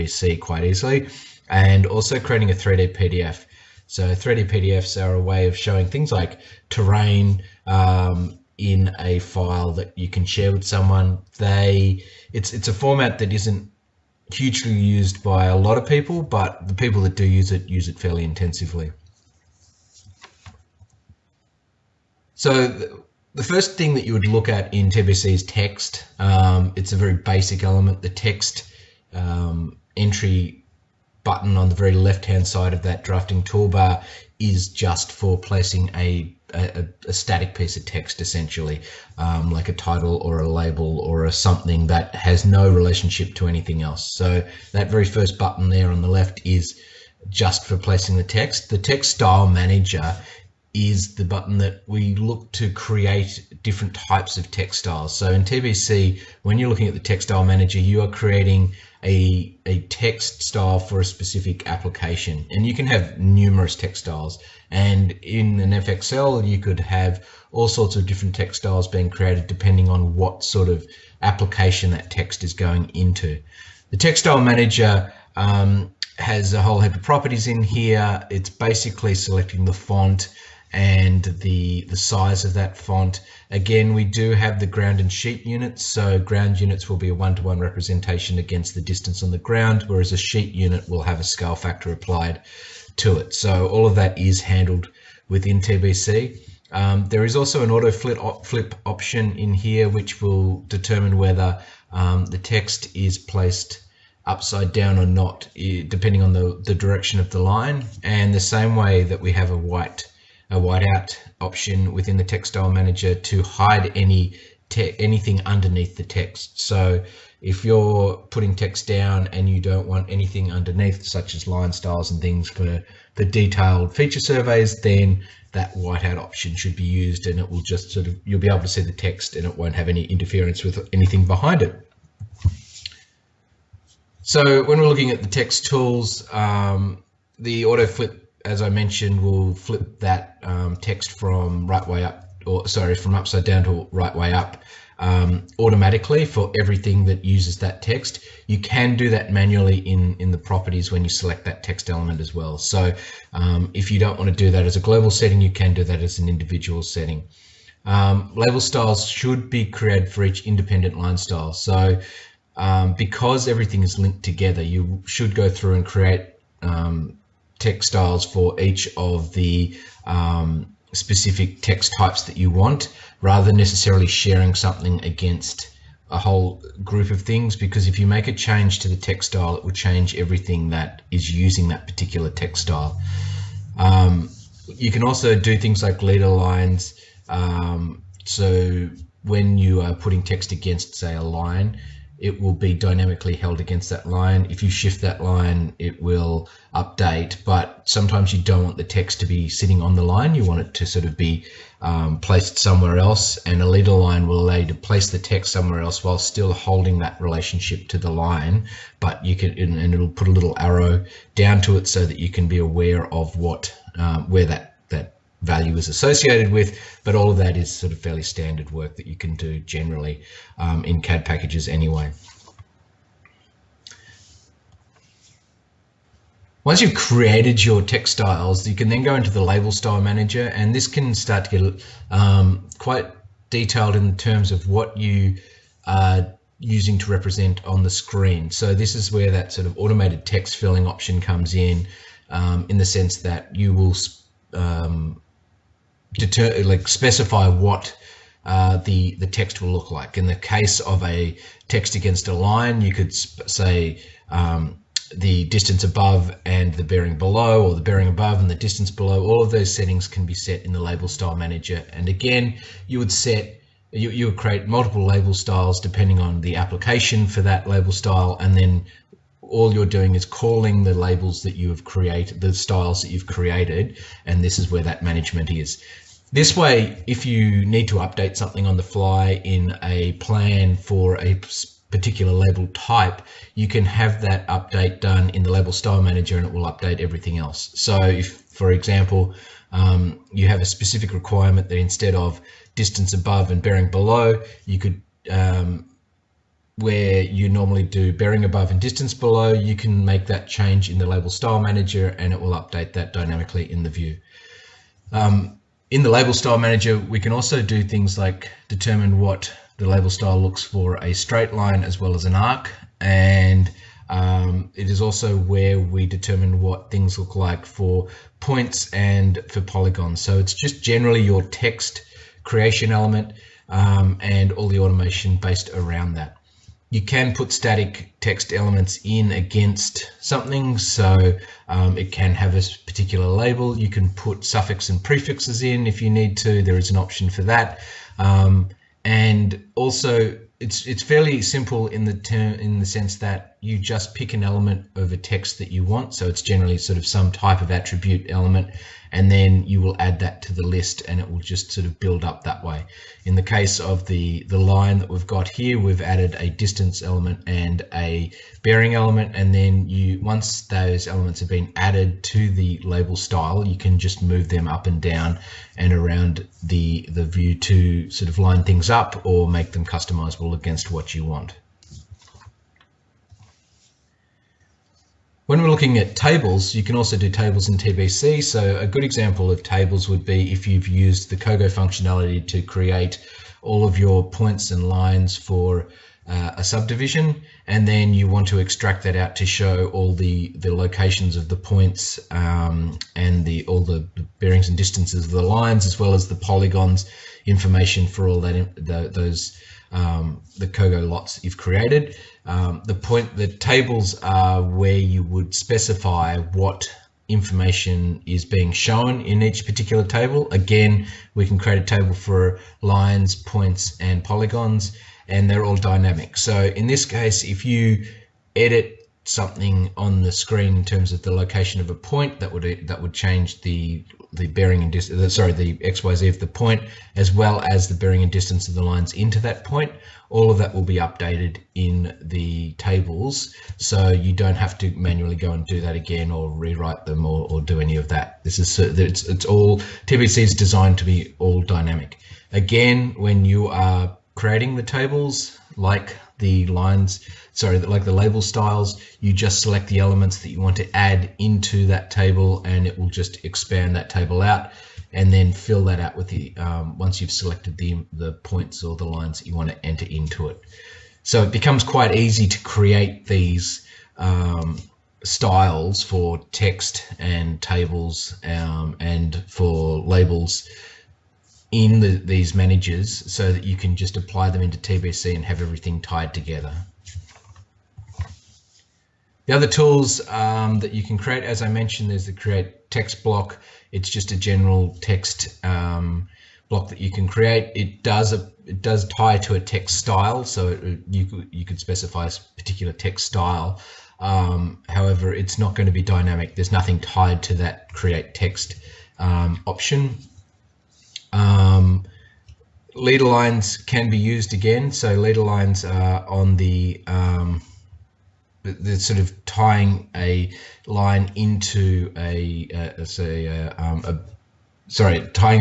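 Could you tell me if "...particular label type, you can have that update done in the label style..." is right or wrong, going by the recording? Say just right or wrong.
right.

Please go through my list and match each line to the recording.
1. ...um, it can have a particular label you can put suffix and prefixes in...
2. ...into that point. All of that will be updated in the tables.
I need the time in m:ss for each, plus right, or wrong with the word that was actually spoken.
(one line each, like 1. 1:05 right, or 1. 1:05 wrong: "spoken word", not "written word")
1. 5:31 right
2. 7:09 right.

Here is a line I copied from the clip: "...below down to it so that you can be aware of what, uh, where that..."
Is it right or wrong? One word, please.
wrong.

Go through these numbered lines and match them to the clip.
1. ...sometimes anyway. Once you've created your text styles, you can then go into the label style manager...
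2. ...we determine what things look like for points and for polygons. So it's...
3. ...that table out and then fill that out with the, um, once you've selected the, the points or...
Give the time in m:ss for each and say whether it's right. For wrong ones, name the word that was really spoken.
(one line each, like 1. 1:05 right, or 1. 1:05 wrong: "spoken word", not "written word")
1. 3:41 wrong: "packages", not "sometimes"
2. 5:15 right
3. 7:33 right.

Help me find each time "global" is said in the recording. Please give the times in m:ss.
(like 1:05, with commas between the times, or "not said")
2:34.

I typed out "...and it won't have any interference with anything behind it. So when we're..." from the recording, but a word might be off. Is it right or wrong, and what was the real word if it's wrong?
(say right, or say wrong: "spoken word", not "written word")
right.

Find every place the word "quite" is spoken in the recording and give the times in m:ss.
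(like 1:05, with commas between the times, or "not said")
0:00, 3:52, 7:41.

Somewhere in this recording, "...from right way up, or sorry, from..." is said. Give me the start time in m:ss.
2:21.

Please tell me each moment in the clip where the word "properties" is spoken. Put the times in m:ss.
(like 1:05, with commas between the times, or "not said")
1:17, 2:30.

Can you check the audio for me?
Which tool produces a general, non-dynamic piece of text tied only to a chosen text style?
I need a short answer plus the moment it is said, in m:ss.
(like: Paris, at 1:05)
create text block, at 8:02.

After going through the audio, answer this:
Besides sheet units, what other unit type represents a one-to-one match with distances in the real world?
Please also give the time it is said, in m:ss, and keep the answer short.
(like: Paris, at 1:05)
ground units, at 1:26.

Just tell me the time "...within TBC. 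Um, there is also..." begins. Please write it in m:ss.
1:35.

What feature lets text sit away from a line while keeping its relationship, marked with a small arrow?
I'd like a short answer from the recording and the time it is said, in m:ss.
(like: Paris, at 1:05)
leader line, at 3:23.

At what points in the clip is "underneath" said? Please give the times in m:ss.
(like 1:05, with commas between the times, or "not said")
1:55, 2:00.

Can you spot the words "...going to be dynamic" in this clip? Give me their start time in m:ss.
8:15.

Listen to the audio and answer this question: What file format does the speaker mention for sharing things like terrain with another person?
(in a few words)
3D PDF.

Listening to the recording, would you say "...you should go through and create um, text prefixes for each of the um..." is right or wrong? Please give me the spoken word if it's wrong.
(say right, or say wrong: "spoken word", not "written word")
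wrong: "styles", not "prefixes".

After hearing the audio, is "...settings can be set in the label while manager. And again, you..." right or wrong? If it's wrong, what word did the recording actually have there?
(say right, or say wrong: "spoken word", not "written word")
wrong: "style", not "while".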